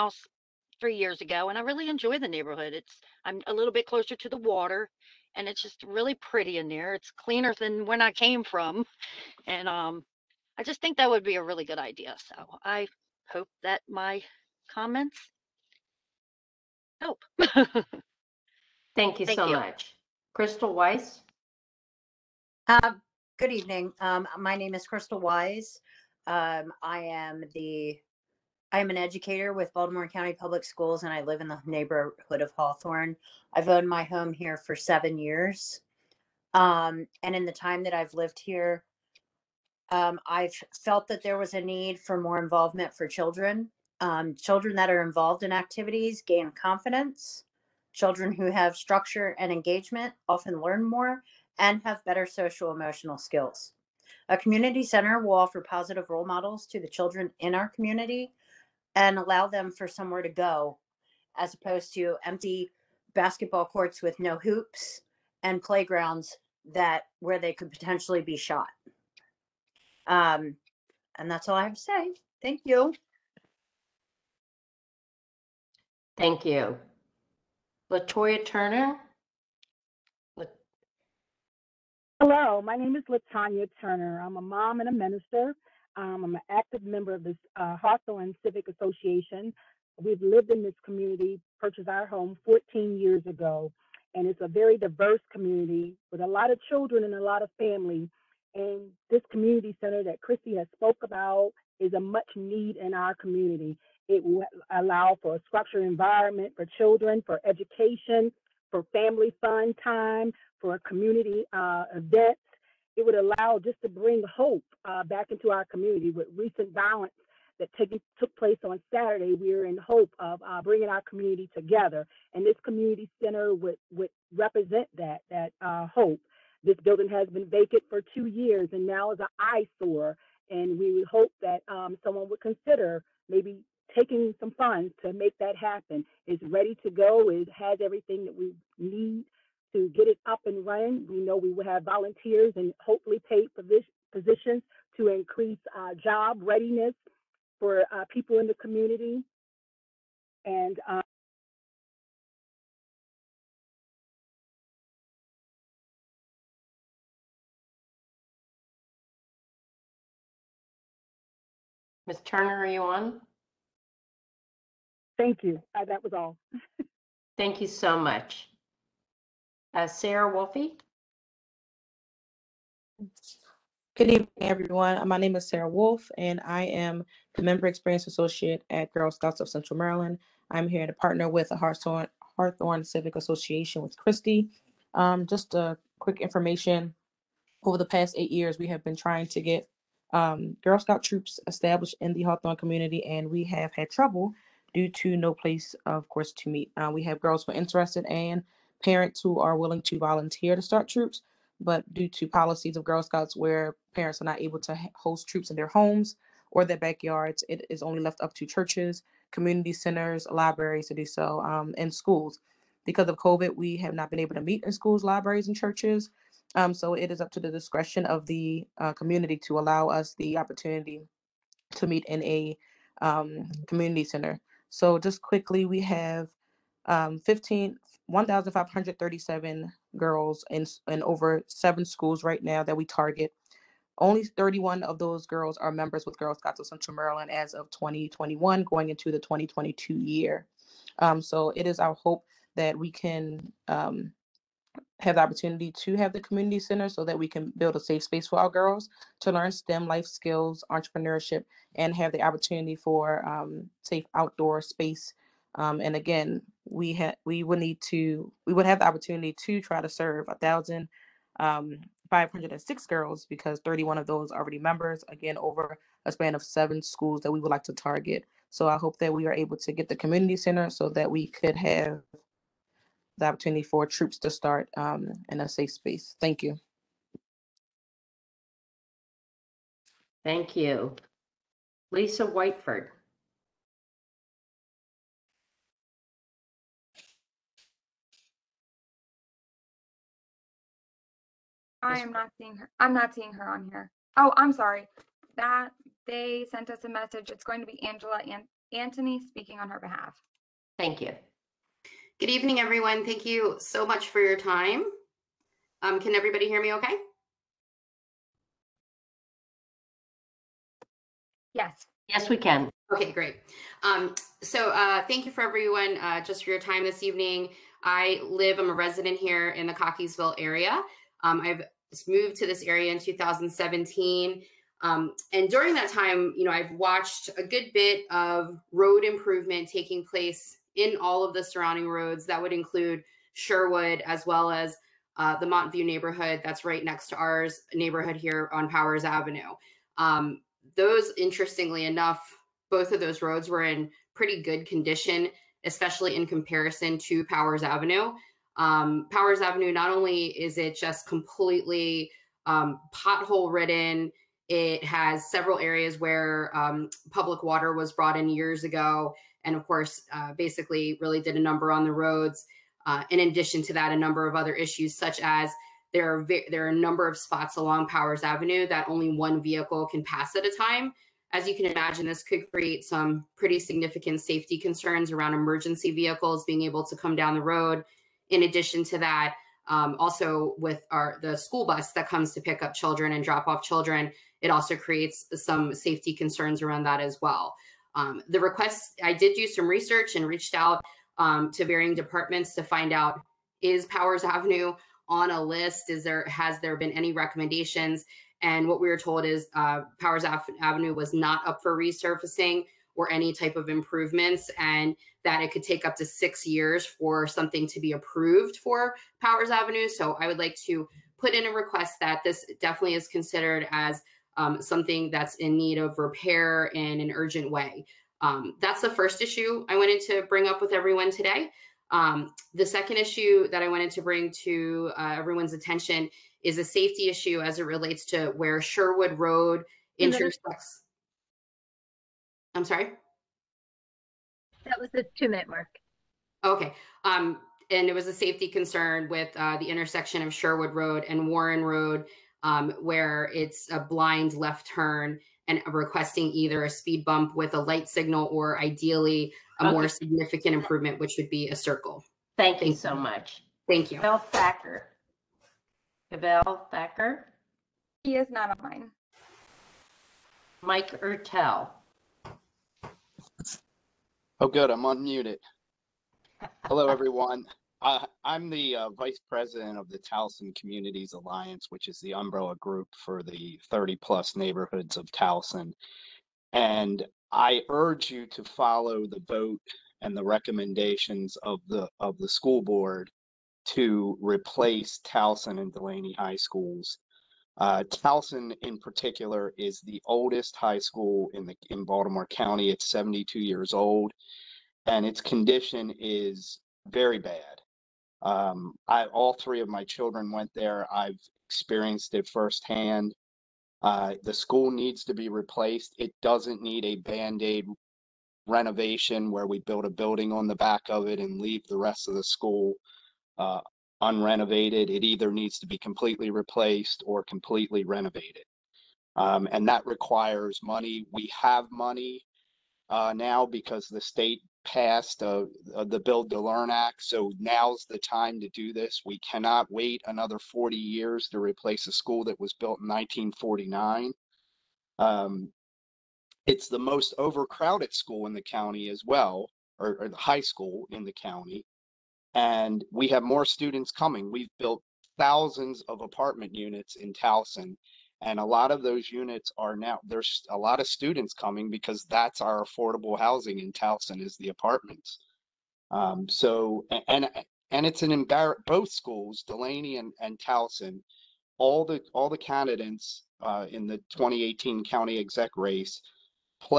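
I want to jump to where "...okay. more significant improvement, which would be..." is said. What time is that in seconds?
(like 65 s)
449 s.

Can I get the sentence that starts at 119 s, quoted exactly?
We are in hope of uh, bringing our community together, and this community center would would represent that that uh, hope.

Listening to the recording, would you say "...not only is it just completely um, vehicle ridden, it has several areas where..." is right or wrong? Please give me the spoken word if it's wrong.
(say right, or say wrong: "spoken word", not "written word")
wrong: "pothole", not "vehicle".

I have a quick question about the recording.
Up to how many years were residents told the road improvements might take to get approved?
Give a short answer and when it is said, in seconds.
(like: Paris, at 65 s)
6 years, at 406 s.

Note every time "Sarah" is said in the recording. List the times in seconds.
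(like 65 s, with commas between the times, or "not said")
169 s, 175 s.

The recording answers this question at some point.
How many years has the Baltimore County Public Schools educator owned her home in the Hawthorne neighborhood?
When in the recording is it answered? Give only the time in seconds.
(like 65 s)
34 s.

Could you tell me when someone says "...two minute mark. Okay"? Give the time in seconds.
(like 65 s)
435 s.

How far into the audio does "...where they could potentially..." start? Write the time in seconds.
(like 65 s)
67 s.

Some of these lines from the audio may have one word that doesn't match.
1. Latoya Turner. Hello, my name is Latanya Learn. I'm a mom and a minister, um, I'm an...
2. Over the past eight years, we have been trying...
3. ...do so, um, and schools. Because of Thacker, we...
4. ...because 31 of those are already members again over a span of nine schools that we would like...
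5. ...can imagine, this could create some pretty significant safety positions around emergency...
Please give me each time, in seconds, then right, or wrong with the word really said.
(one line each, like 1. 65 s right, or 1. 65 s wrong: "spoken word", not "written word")
1. 77 s wrong: "Turner", not "Learn"
2. 187 s right
3. 210 s wrong: "COVID", not "Thacker"
4. 263 s wrong: "seven", not "nine"
5. 371 s wrong: "concerns", not "positions".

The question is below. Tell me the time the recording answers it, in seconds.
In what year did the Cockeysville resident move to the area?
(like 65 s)
322 s.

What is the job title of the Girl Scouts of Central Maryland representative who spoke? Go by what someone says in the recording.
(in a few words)
Member Experience Associate.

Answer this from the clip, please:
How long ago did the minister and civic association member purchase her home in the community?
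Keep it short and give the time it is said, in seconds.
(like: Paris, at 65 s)
14 years, at 92 s.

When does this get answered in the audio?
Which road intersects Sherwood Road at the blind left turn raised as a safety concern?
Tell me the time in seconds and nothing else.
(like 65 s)
441 s.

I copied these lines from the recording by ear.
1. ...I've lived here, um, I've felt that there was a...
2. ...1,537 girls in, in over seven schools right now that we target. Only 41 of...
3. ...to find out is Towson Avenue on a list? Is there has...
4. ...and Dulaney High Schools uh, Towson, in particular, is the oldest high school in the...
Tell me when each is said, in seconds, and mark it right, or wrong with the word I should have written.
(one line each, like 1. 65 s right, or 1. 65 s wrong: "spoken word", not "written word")
1. 37 s right
2. 228 s wrong: "31", not "41"
3. 392 s wrong: "Powers", not "Towson"
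4. 485 s right.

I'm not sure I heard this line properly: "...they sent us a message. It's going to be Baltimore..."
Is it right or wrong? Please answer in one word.
wrong.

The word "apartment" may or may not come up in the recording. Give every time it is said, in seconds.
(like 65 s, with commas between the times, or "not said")
546 s, 554 s.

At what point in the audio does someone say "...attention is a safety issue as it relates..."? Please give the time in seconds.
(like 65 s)
425 s.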